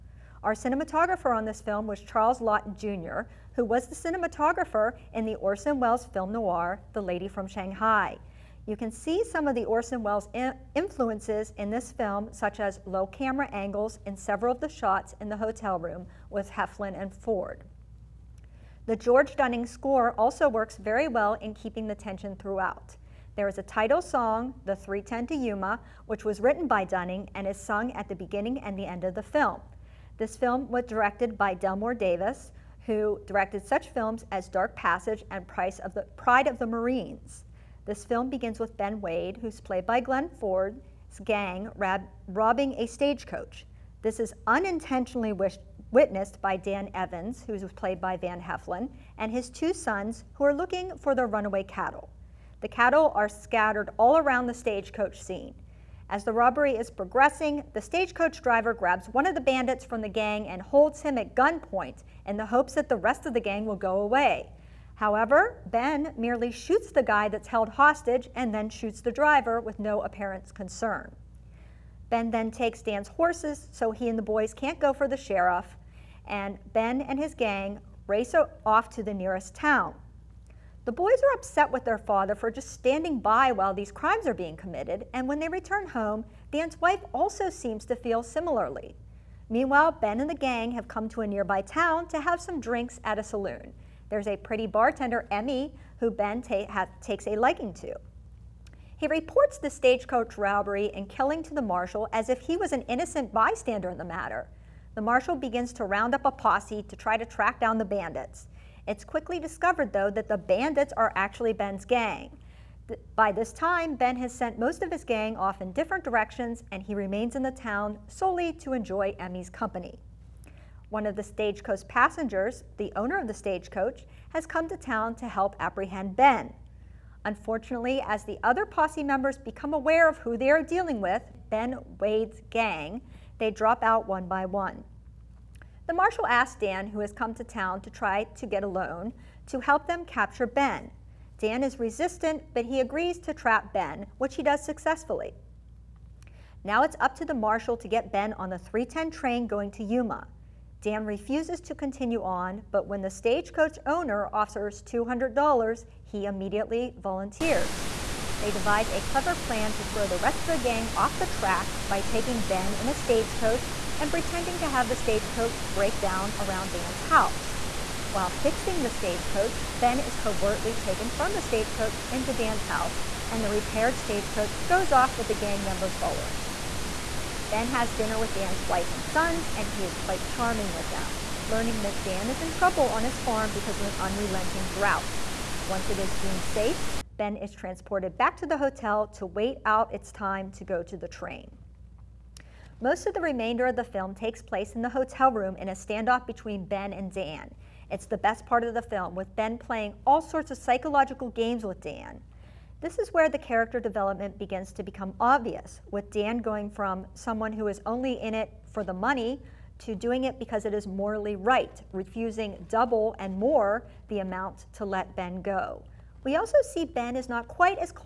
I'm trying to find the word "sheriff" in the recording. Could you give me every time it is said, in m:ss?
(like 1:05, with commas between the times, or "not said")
1:15.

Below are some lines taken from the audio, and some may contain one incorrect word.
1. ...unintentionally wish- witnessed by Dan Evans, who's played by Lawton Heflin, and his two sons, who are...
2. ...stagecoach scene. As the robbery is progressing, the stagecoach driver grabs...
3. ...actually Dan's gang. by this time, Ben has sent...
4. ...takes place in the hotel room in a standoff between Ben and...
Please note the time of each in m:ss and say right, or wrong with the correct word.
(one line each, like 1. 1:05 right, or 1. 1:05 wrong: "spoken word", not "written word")
1. 0:44 wrong: "Van", not "Lawton"
2. 0:54 right
3. 1:51 wrong: "Ben", not "Dan"
4. 3:14 right.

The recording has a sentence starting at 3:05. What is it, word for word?
Once it is deemed safe, Ben is transported back to the hotel to wait out its time to go to the train.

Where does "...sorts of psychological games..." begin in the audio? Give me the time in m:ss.
3:20.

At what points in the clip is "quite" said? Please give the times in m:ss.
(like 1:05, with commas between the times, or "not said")
2:59, 3:37.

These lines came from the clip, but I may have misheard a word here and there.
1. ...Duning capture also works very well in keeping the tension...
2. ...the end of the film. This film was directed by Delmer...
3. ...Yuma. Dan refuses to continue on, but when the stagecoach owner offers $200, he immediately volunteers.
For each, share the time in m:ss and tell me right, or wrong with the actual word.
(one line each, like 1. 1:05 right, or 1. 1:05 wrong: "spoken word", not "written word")
1. 0:19 wrong: "score", not "capture"
2. 0:28 right
3. 2:29 right.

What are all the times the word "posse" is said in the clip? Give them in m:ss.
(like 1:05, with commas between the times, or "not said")
1:46, 2:08.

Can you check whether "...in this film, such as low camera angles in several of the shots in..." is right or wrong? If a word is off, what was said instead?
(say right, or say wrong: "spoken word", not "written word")
right.